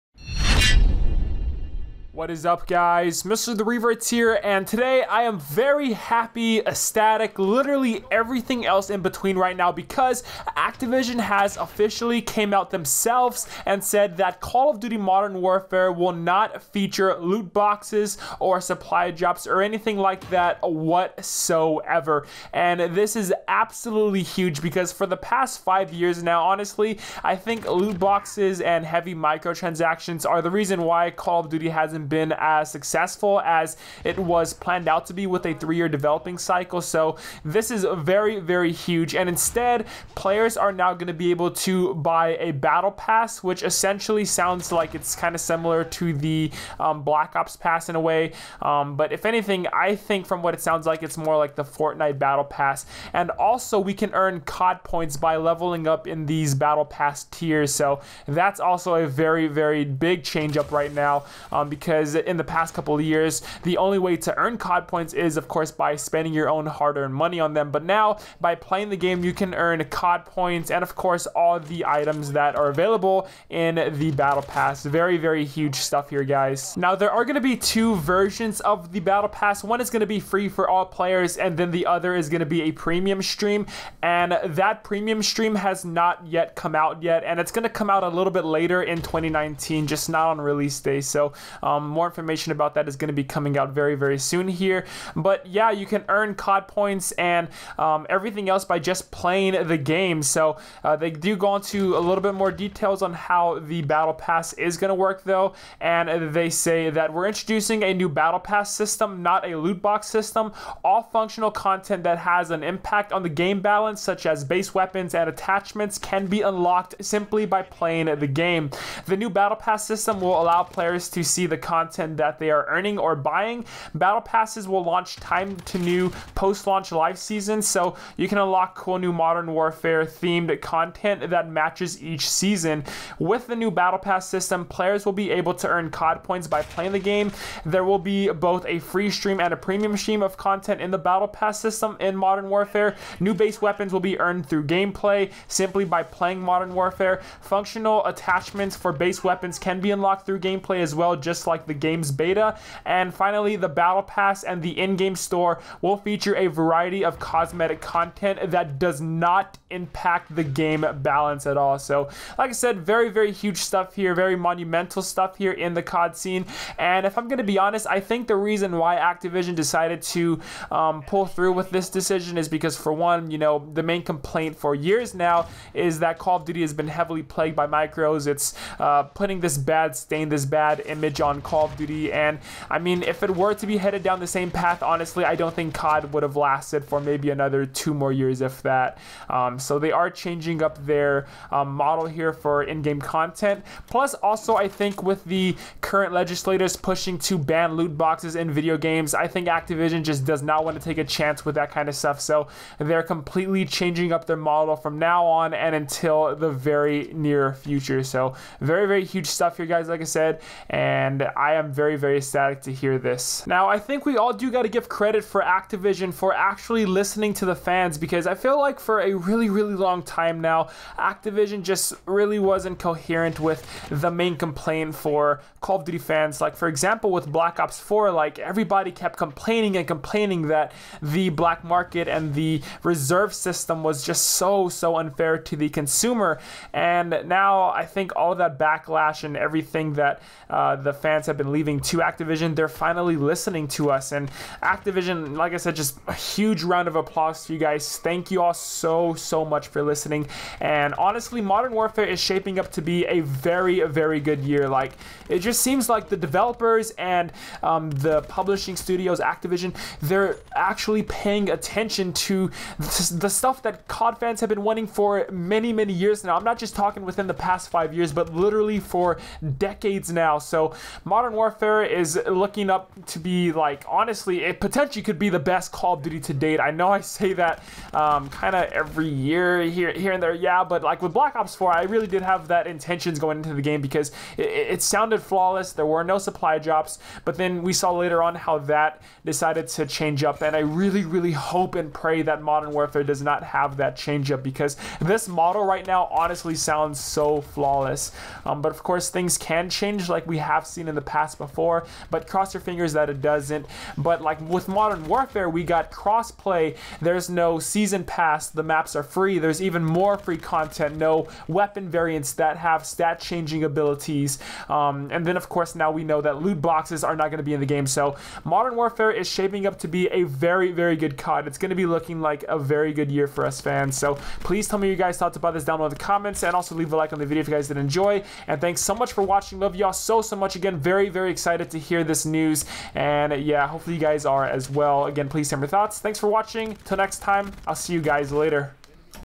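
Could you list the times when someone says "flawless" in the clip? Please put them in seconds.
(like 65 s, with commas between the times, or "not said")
285 s, 297 s.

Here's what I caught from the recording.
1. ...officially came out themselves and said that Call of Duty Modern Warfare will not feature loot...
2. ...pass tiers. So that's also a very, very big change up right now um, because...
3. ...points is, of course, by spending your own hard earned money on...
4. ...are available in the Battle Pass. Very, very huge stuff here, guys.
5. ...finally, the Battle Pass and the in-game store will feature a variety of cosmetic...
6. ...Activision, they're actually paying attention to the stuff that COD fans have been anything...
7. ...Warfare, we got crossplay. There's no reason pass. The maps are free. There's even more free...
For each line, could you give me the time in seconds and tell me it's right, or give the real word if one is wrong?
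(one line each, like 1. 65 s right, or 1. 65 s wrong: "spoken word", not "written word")
1. 11 s right
2. 56 s right
3. 64 s right
4. 72 s right
5. 153 s right
6. 259 s wrong: "wanting", not "anything"
7. 305 s wrong: "season", not "reason".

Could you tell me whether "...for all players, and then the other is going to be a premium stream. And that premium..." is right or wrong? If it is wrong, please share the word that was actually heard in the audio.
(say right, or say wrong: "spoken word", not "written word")
right.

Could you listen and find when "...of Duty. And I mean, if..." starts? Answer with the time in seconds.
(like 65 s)
181 s.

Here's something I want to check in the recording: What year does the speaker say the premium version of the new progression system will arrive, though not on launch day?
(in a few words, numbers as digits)
2019.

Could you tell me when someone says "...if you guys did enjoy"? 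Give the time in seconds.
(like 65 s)
327 s.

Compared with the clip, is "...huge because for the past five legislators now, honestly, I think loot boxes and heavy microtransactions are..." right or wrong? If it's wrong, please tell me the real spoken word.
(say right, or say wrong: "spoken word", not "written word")
wrong: "years", not "legislators".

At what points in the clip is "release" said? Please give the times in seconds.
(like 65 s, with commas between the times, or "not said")
90 s.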